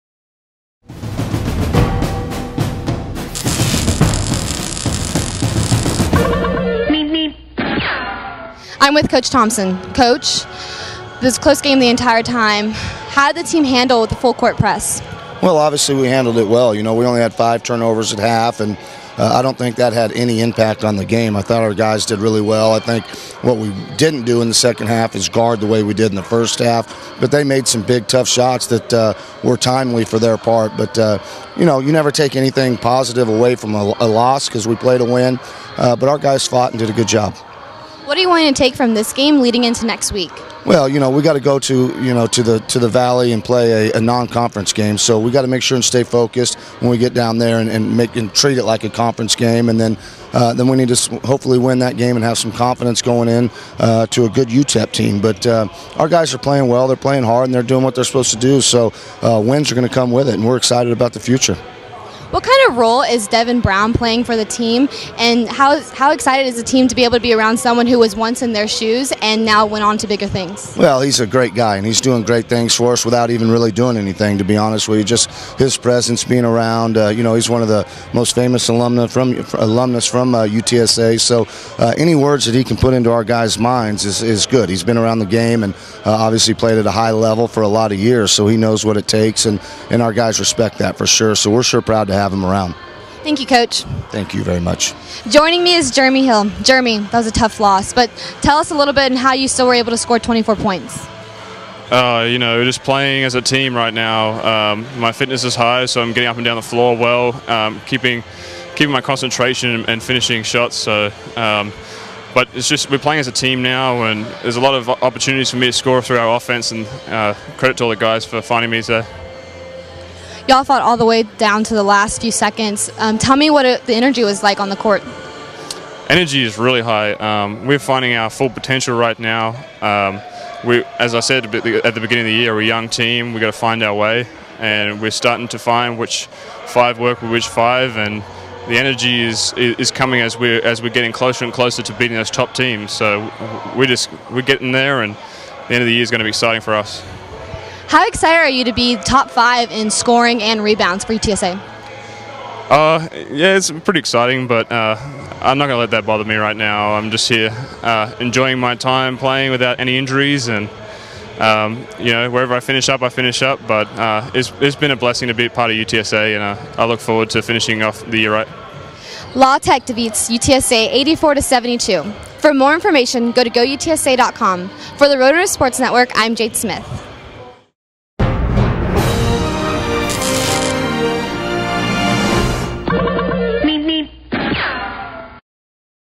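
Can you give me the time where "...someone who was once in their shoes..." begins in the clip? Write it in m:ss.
1:07.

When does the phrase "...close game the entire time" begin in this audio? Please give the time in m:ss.
0:11.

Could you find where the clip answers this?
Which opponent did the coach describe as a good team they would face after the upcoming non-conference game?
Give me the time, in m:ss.
0:54.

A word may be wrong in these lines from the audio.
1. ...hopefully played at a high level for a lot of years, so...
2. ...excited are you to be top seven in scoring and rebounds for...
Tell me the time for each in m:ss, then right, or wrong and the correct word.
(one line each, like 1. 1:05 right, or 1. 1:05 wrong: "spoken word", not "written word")
1. 1:26 wrong: "obviously", not "hopefully"
2. 2:28 wrong: "five", not "seven".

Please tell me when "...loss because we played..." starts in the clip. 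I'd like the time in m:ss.
0:34.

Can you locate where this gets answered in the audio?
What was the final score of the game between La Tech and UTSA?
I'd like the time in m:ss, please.
2:50.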